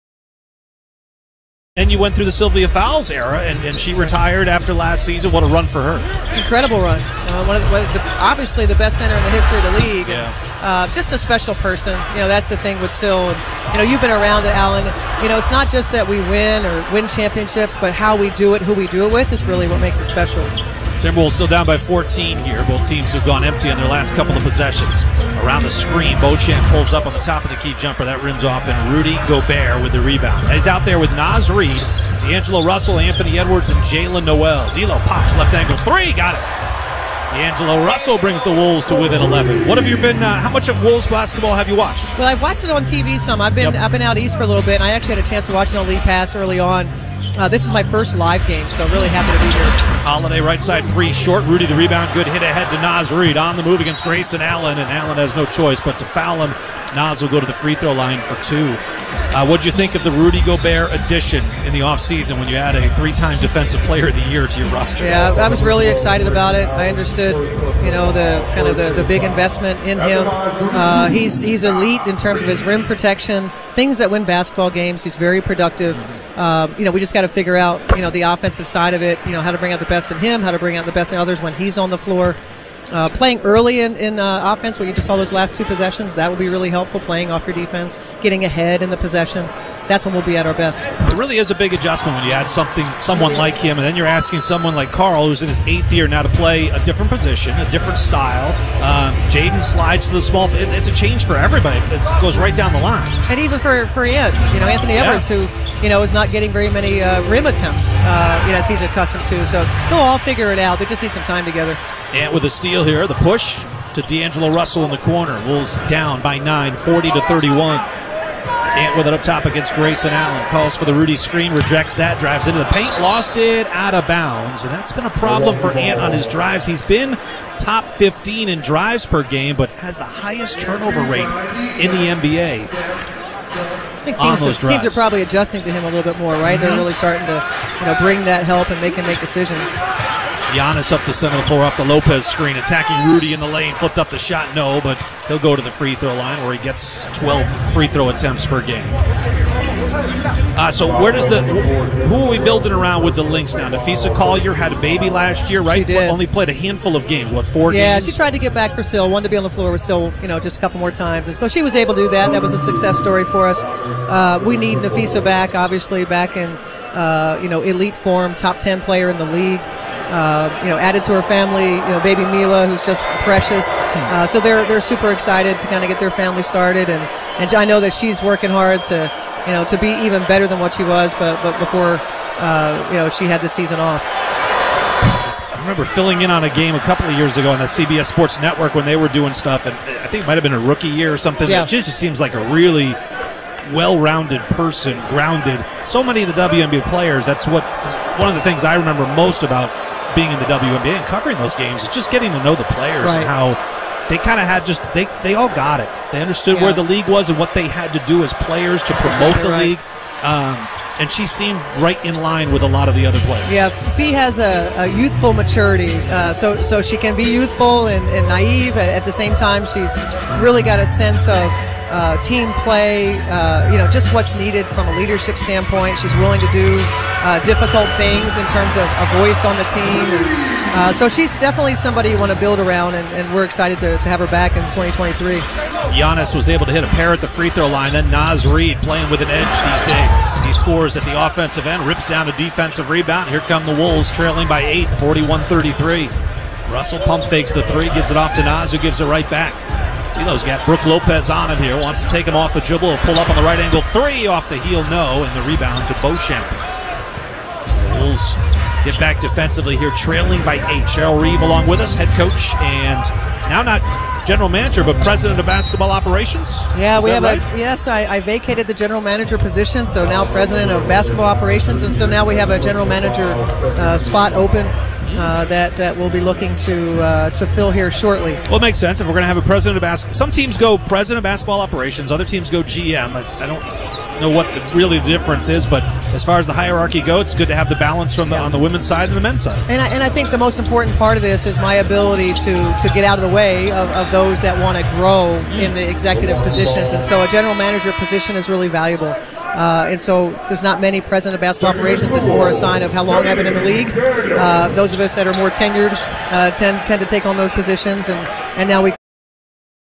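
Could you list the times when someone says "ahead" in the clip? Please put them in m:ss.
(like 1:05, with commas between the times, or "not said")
0:52, 1:28.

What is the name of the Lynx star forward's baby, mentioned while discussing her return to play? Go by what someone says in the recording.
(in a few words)
Mila.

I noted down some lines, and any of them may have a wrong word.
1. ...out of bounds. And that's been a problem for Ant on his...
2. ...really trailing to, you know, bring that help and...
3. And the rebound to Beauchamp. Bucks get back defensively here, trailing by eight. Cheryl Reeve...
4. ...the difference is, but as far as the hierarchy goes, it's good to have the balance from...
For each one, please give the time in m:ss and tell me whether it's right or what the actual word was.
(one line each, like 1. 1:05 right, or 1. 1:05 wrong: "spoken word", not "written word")
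1. 2:03 right
2. 2:16 wrong: "starting", not "trailing"
3. 4:15 right
4. 4:44 right.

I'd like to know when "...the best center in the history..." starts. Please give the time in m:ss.
0:08.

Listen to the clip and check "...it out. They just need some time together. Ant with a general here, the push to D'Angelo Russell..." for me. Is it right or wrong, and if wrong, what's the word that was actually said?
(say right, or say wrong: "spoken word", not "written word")
wrong: "steal", not "general".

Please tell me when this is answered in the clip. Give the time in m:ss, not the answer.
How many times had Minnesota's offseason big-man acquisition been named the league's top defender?
1:02.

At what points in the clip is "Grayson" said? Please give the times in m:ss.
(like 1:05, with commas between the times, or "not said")
0:54, 1:59.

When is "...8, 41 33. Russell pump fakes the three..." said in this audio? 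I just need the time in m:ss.
4:04.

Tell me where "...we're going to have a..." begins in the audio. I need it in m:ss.
4:39.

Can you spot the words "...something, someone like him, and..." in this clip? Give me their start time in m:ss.
1:32.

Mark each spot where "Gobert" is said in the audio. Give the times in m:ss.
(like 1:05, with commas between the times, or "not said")
0:29, 1:00.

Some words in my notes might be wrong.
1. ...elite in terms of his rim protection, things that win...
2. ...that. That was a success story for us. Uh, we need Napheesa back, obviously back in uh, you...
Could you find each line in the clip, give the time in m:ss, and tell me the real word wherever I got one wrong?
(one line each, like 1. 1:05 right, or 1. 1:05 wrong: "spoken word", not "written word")
1. 1:11 right
2. 2:42 right.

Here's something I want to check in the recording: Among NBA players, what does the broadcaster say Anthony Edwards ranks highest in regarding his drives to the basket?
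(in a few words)
turnover rate.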